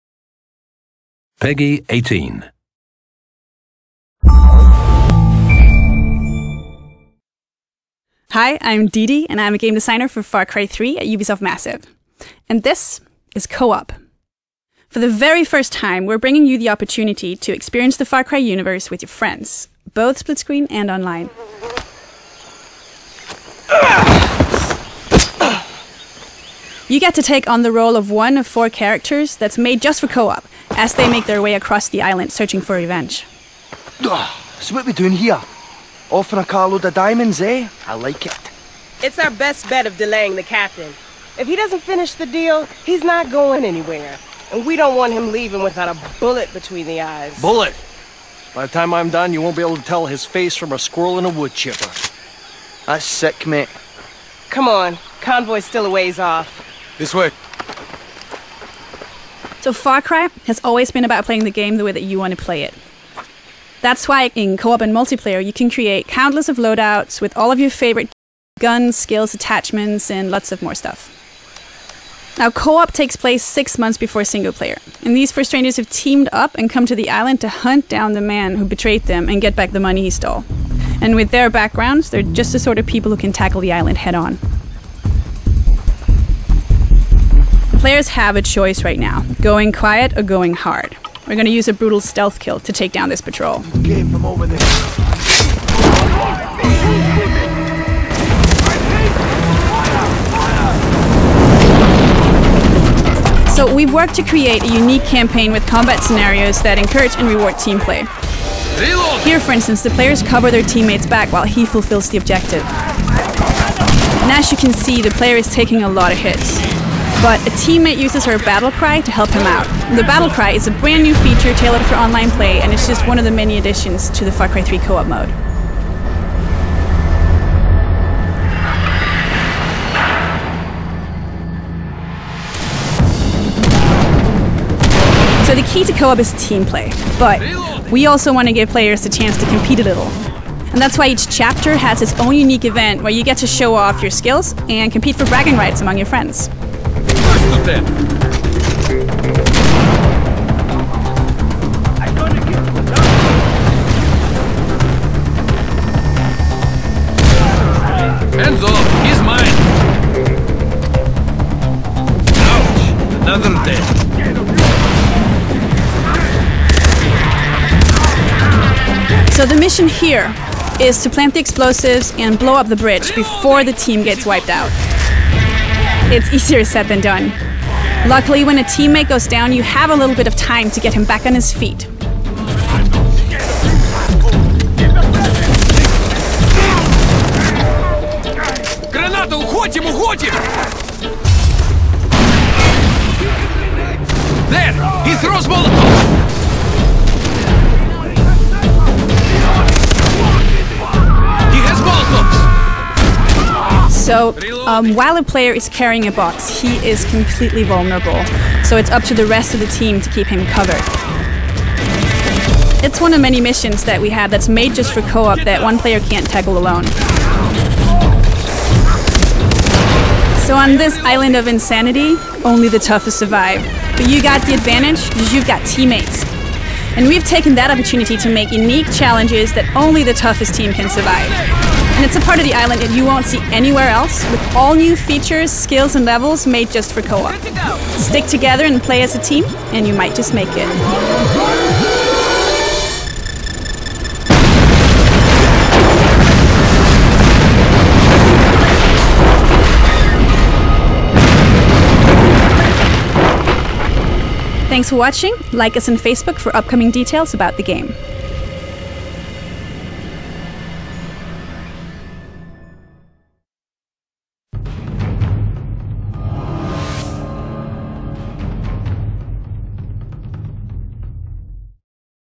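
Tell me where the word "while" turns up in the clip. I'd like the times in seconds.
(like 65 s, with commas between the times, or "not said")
111 s, 204 s.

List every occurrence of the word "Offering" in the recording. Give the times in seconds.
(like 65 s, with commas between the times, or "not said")
36 s.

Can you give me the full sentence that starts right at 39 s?
It's our best bet of delaying the captain.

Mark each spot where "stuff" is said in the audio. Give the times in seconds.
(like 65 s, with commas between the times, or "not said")
70 s.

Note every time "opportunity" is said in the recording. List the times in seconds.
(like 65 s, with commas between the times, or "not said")
16 s, 227 s.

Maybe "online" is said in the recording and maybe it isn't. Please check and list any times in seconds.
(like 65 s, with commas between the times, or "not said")
20 s, 121 s.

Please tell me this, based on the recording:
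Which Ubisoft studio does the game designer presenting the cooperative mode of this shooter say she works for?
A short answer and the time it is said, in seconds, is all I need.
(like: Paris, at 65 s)
Ubisoft Massive, at 11 s.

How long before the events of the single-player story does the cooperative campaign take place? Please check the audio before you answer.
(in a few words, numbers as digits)
6 months.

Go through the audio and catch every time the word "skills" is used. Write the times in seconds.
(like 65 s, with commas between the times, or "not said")
68 s, 144 s, 235 s.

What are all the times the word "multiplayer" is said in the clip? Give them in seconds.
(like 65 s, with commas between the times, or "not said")
64 s.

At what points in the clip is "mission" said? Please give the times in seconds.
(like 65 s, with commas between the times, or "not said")
169 s, 213 s.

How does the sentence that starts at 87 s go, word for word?
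Players have a choice right now going quiet or going hard.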